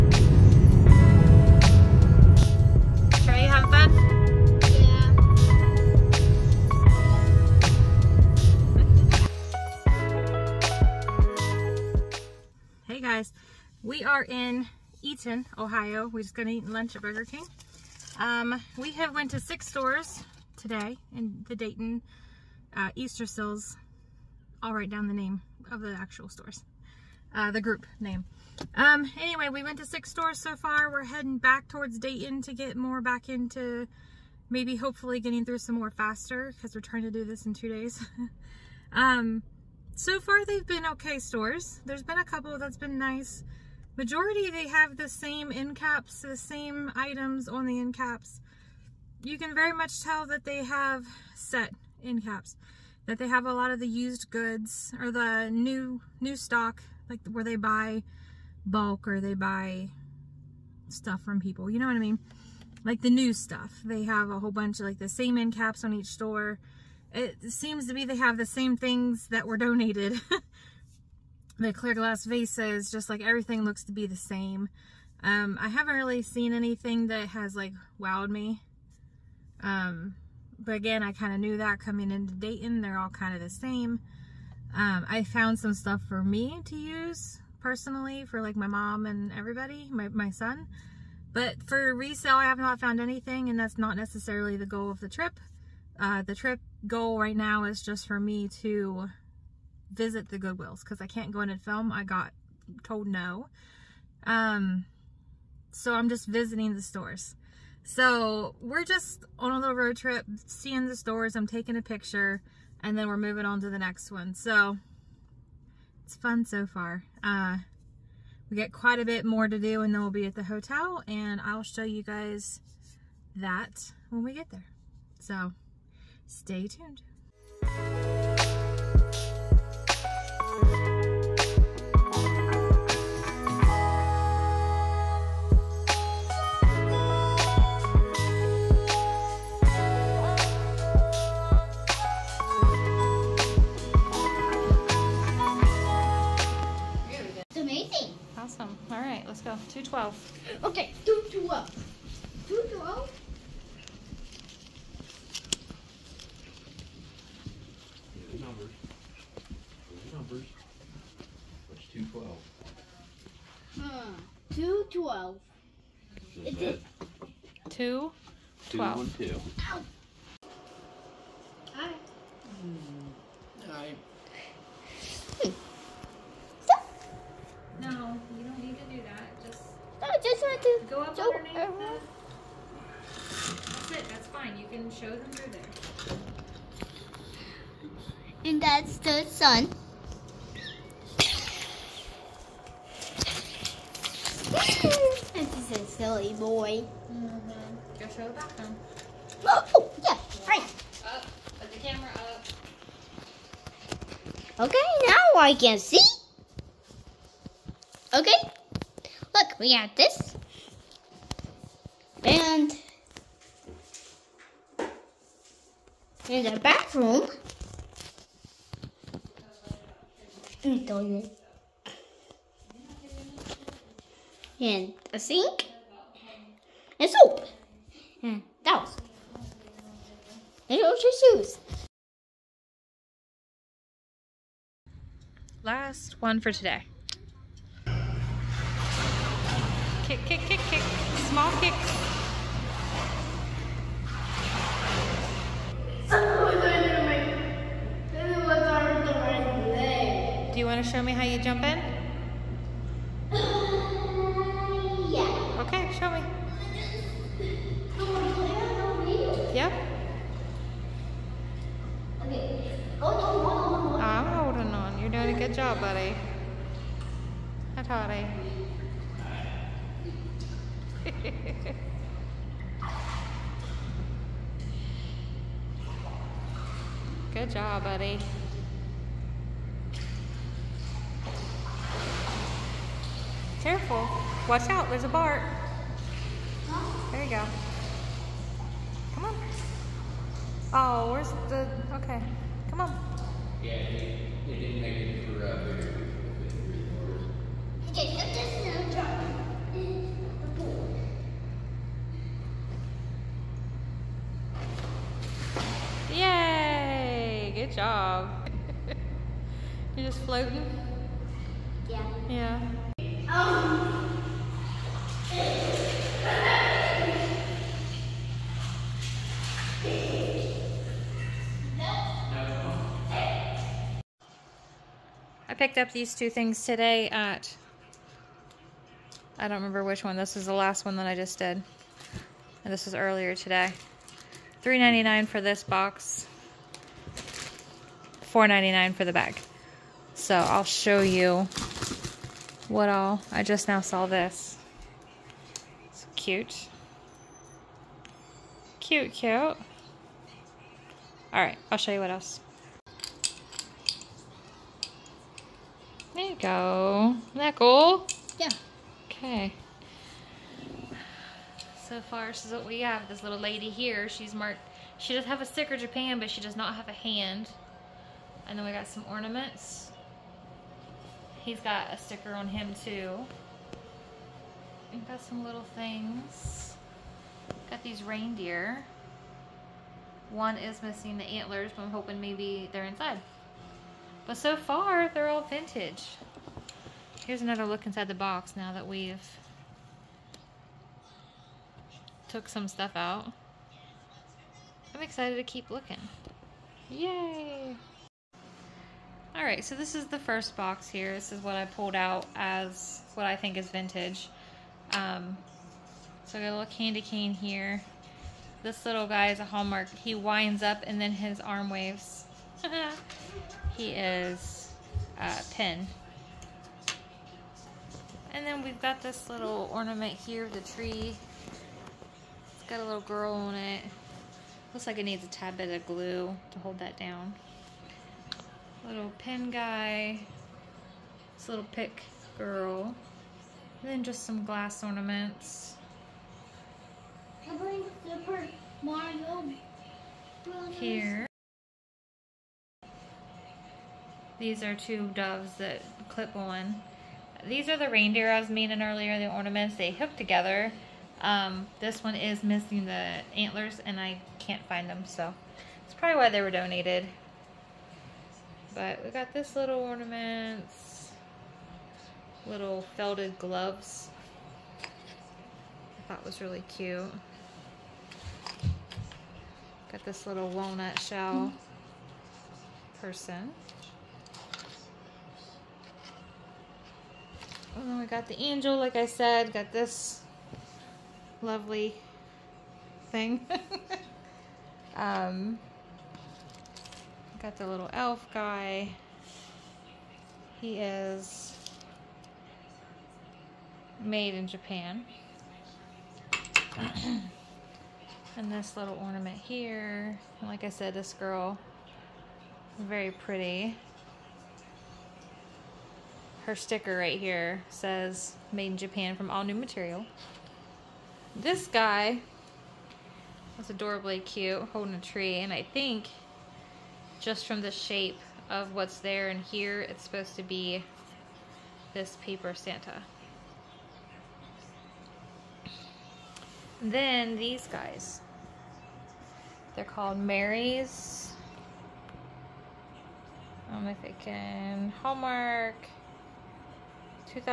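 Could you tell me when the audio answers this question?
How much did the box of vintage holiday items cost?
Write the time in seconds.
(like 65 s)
334 s.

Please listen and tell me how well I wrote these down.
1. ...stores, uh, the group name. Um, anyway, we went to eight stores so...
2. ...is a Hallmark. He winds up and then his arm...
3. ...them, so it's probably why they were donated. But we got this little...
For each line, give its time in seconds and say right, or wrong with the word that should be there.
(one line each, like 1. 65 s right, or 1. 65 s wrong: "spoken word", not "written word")
1. 26 s wrong: "six", not "eight"
2. 409 s right
3. 454 s right.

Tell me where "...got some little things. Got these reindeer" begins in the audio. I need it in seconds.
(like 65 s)
375 s.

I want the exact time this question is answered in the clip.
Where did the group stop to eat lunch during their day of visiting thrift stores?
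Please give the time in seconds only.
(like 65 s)
17 s.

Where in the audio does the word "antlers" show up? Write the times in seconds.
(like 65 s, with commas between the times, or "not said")
381 s, 453 s.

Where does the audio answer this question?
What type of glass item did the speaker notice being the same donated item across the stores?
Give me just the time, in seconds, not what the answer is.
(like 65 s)
71 s.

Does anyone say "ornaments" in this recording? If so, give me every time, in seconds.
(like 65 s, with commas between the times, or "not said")
369 s, 419 s, 434 s, 449 s, 459 s, 499 s.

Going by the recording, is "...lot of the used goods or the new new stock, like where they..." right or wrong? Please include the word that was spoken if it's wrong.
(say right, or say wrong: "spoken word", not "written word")
right.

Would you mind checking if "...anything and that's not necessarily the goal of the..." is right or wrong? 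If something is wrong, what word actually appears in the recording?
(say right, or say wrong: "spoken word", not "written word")
right.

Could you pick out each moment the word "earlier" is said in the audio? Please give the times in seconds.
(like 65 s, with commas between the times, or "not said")
332 s, 448 s.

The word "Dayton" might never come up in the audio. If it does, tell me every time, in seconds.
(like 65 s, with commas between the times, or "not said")
15 s, 21 s, 31 s, 82 s.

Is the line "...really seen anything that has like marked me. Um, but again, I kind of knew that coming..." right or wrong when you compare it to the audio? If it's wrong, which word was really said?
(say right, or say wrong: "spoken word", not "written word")
wrong: "wowed", not "marked".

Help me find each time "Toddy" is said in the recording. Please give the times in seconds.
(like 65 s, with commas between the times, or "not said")
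267 s.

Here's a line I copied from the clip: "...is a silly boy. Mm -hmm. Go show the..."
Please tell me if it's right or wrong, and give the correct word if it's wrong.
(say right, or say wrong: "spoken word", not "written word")
right.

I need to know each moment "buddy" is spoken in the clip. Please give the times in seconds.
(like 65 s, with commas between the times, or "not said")
265 s, 277 s.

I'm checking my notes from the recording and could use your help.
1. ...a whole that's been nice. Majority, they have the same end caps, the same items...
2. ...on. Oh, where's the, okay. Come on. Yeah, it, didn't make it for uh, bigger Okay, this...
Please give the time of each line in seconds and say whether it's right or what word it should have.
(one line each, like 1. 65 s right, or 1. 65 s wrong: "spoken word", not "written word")
1. 42 s wrong: "couple", not "whole"
2. 289 s right.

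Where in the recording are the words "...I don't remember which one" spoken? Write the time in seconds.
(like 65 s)
329 s.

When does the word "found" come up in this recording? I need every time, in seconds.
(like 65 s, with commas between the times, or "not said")
85 s, 92 s.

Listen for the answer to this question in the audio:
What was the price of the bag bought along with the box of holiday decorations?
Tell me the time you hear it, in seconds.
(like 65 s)
338 s.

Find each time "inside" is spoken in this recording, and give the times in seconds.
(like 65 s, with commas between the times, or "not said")
382 s, 387 s.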